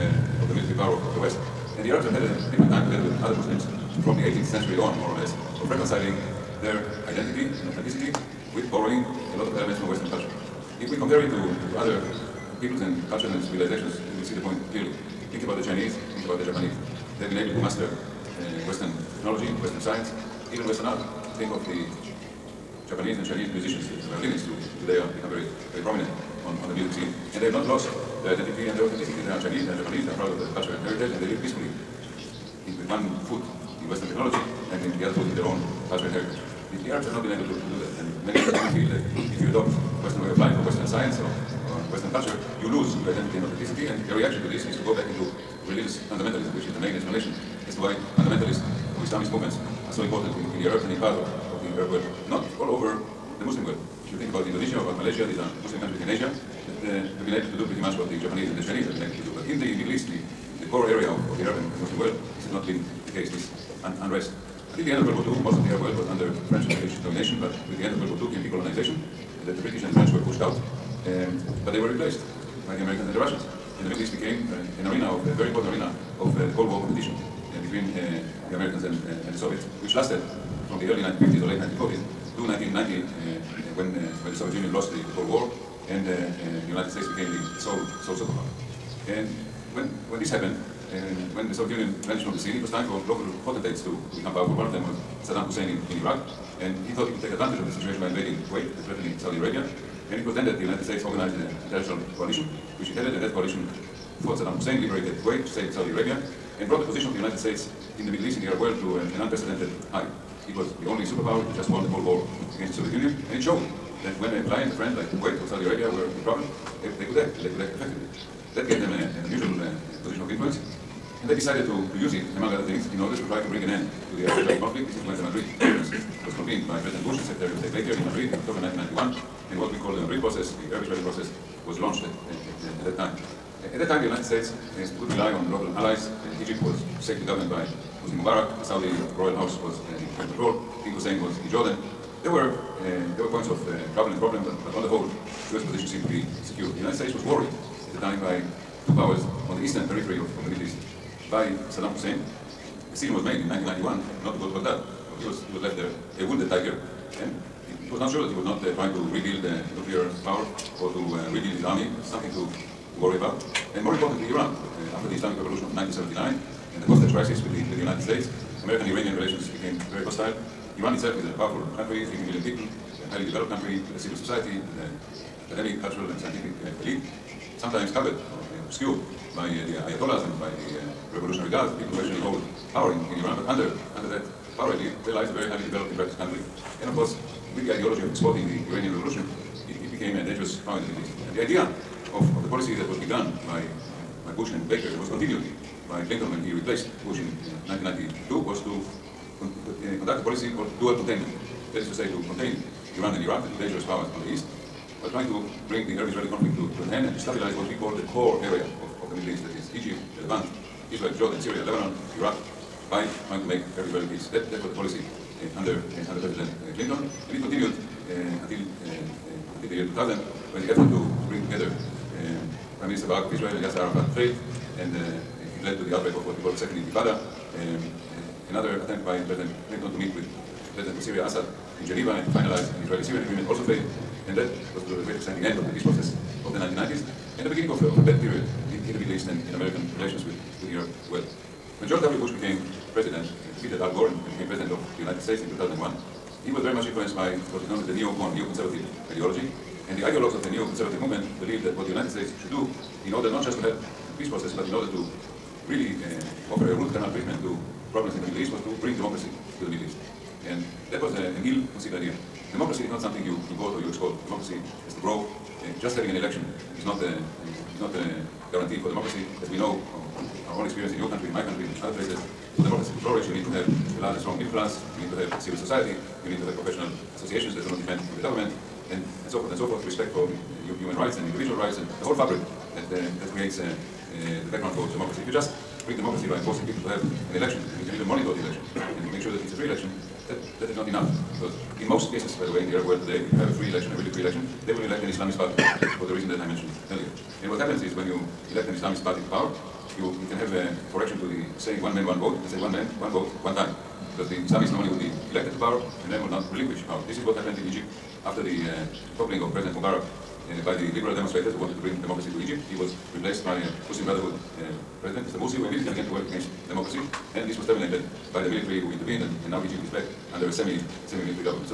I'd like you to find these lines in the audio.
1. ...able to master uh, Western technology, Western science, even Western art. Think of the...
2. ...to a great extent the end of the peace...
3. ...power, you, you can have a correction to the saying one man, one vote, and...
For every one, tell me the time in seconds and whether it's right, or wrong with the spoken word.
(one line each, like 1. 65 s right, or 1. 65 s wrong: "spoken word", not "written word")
1. 17 s right
2. 234 s right
3. 299 s right.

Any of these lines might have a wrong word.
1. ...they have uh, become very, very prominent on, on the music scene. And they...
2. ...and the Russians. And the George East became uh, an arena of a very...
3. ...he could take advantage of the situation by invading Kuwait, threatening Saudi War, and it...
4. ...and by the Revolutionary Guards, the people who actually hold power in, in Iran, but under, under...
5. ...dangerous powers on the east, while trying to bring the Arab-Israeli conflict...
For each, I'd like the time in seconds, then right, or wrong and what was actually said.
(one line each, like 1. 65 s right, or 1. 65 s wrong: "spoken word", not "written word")
1. 24 s right
2. 73 s wrong: "Middle", not "George"
3. 97 s wrong: "Arabia", not "War"
4. 180 s right
5. 203 s right.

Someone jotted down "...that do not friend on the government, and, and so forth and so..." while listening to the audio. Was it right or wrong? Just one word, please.
wrong.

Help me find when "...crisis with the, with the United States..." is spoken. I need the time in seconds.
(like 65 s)
167 s.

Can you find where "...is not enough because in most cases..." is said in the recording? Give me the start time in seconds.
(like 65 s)
290 s.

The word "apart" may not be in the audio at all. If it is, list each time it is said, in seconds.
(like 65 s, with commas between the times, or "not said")
not said.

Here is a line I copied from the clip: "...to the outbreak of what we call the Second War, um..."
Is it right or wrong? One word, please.
wrong.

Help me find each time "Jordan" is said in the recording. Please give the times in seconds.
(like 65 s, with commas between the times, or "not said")
141 s, 211 s.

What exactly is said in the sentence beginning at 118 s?
That gave them a, an unusual uh, position of influence.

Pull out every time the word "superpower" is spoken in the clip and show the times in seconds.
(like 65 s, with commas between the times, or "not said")
88 s, 111 s.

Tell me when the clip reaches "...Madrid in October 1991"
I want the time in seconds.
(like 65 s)
128 s.